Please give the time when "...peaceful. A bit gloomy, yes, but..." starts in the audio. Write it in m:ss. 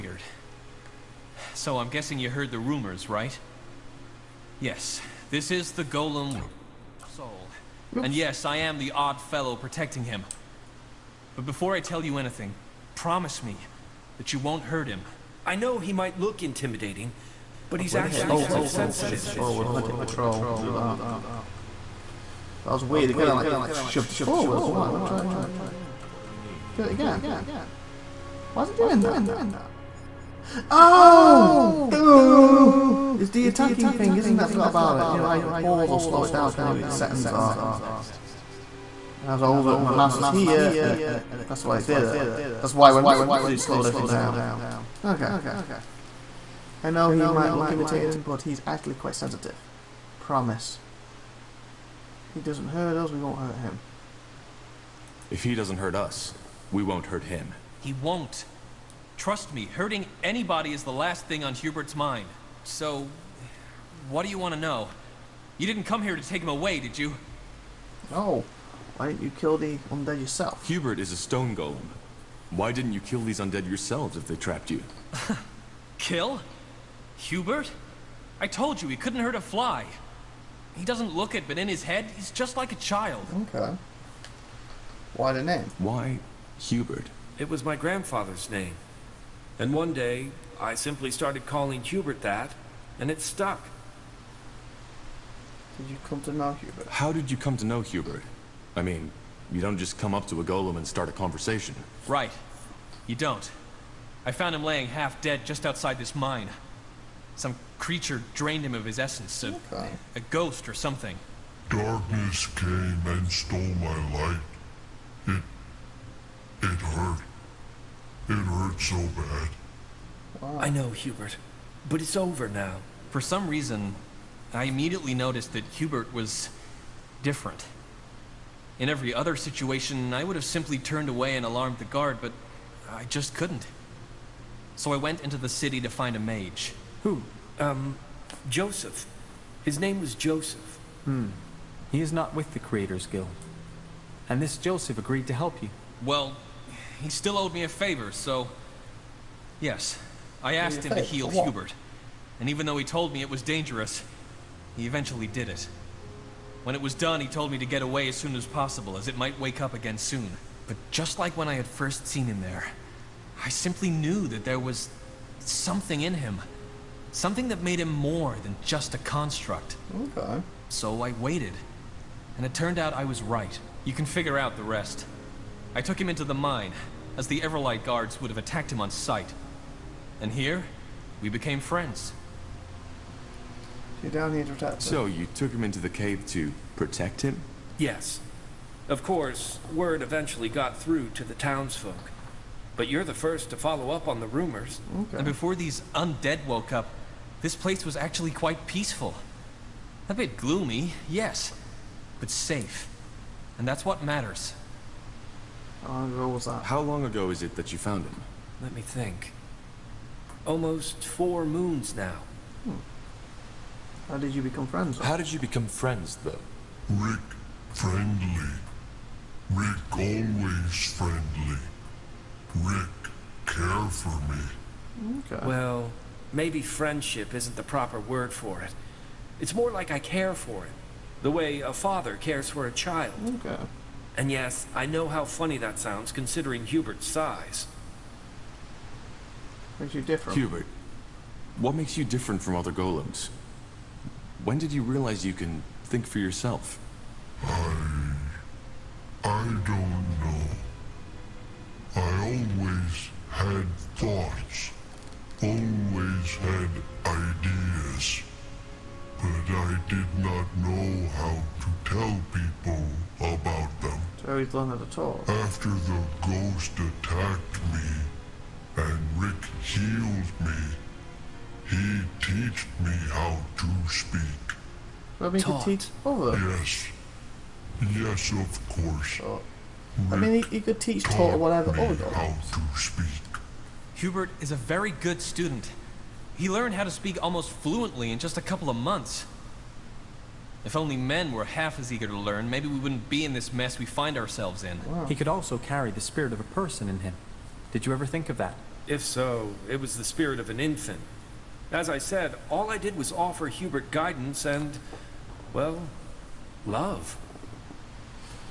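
3:18.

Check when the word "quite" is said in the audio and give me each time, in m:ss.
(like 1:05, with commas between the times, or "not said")
0:18, 0:48, 3:18.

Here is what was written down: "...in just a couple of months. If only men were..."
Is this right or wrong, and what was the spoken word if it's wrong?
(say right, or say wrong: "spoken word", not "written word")
right.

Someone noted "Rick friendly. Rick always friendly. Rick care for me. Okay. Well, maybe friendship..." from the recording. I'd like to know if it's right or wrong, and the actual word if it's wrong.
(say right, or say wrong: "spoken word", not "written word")
right.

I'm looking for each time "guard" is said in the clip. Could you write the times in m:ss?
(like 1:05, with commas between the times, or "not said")
2:11, 2:57.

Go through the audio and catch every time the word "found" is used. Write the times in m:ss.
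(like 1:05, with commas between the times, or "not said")
1:44, 3:27.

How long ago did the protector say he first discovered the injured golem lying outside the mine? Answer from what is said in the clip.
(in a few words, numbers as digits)
Almost 4 moons.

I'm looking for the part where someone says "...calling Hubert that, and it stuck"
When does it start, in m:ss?
1:31.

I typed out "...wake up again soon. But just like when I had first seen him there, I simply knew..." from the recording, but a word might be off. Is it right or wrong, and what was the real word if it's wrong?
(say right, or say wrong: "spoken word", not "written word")
right.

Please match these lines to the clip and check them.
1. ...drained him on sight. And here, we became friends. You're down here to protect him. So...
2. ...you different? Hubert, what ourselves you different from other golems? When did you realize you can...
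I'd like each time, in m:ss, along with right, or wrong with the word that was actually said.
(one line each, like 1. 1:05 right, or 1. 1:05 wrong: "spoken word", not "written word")
1. 2:58 wrong: "attacked", not "drained"
2. 3:59 wrong: "makes", not "ourselves".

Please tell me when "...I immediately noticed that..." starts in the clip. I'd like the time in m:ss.
2:04.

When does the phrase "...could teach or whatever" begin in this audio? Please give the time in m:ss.
4:40.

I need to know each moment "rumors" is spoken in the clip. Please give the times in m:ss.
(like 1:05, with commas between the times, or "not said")
0:02, 3:14.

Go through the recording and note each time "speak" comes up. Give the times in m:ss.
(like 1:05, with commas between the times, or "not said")
4:33, 4:46.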